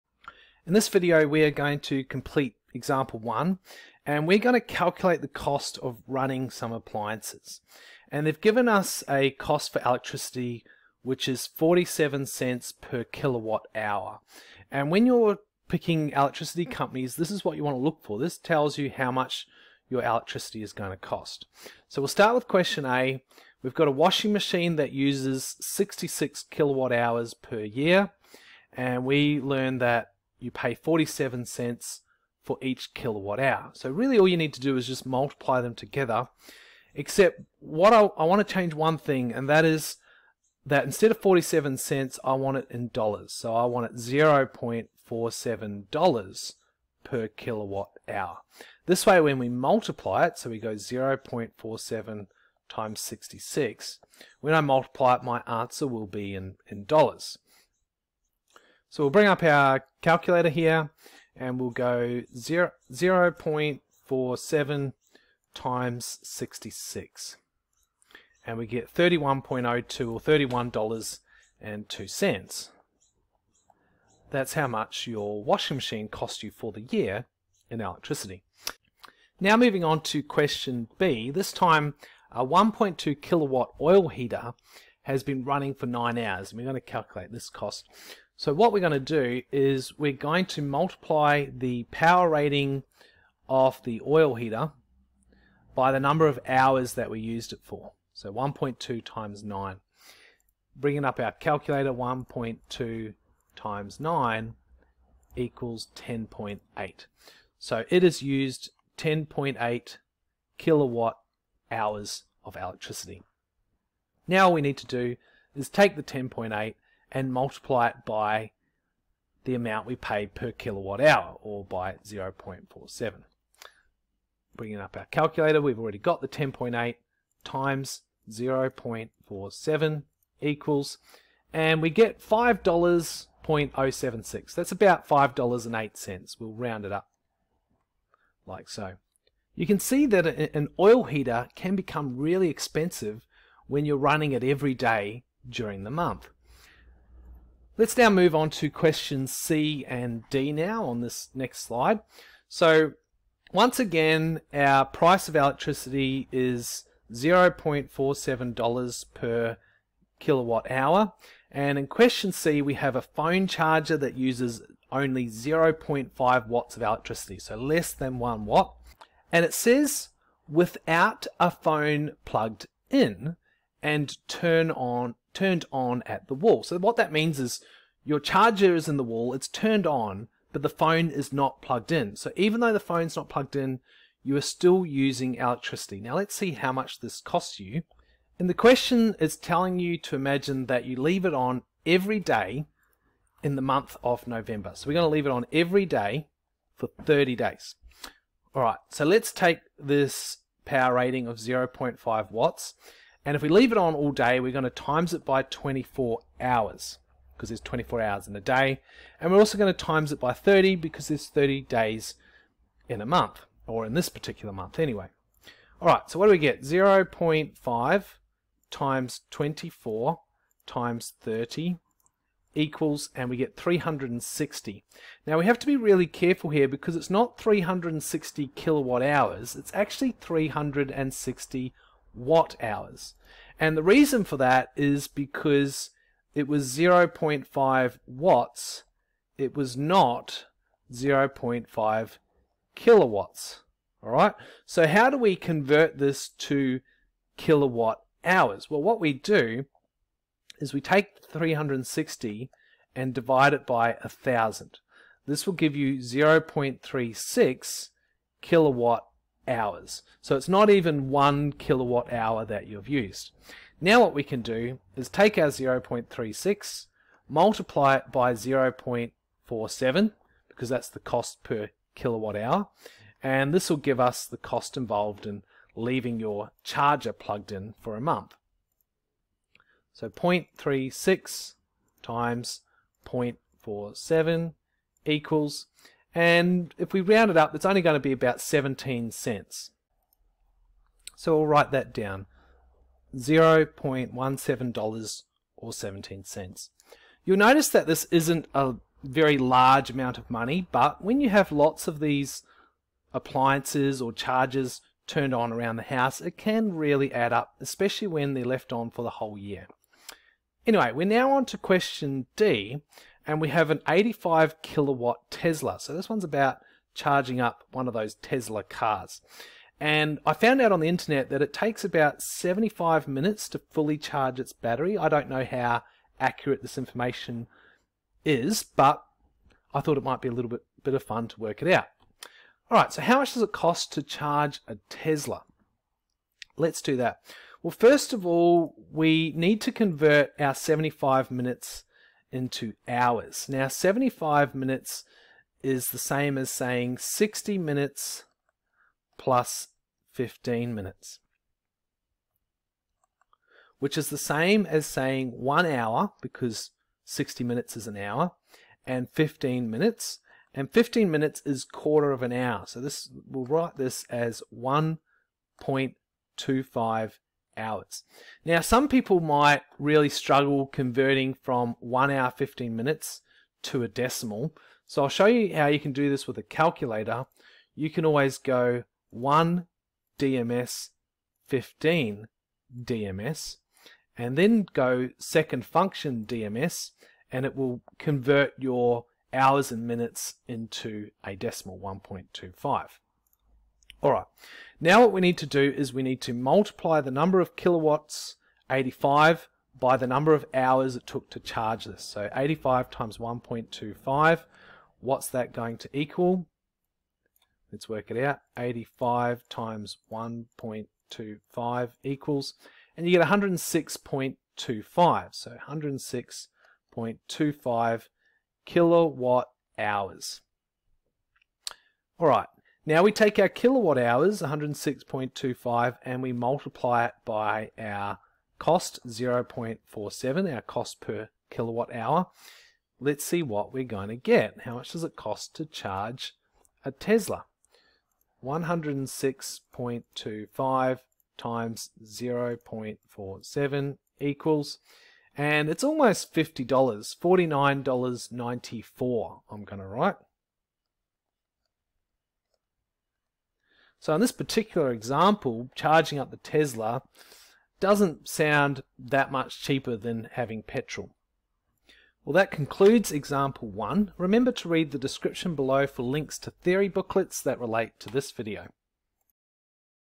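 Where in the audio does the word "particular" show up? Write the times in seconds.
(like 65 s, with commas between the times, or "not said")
214 s, 454 s.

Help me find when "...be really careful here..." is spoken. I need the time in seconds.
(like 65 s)
225 s.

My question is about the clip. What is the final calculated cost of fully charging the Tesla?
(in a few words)
$49.94.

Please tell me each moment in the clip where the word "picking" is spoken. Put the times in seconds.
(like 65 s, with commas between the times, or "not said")
15 s.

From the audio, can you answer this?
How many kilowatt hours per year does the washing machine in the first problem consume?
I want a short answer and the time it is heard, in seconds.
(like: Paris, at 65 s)
66, at 25 s.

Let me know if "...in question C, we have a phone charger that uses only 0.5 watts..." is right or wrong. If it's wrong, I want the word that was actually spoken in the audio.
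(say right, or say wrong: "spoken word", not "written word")
right.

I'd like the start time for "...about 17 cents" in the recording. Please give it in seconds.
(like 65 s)
288 s.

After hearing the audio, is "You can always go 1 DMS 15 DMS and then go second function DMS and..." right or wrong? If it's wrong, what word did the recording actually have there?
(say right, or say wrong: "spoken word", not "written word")
right.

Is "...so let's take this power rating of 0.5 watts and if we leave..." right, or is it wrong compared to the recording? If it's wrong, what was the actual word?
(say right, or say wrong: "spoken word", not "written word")
right.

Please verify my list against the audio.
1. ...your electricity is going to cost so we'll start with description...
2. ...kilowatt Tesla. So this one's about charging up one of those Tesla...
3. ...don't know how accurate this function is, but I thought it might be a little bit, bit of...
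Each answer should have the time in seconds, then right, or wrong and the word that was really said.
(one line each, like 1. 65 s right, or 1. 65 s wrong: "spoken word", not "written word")
1. 19 s wrong: "question", not "description"
2. 314 s right
3. 325 s wrong: "information", not "function".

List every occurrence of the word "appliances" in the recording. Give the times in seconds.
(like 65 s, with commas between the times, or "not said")
6 s, 303 s.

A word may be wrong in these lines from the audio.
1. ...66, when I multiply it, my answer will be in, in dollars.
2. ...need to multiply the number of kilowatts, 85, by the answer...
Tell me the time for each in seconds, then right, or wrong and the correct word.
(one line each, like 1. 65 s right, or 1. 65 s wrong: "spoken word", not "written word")
1. 52 s right
2. 396 s wrong: "number", not "answer".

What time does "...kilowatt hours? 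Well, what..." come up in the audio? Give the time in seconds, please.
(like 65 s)
247 s.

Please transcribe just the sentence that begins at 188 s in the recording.
And the question is telling you to imagine that you leave it on every day in the month of November.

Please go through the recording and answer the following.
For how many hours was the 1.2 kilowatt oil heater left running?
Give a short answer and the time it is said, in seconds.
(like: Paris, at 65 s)
9 hours, at 85 s.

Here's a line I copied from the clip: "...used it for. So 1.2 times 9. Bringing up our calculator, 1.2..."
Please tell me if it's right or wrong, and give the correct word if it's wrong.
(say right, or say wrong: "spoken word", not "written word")
right.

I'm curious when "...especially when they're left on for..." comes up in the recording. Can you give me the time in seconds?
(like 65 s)
307 s.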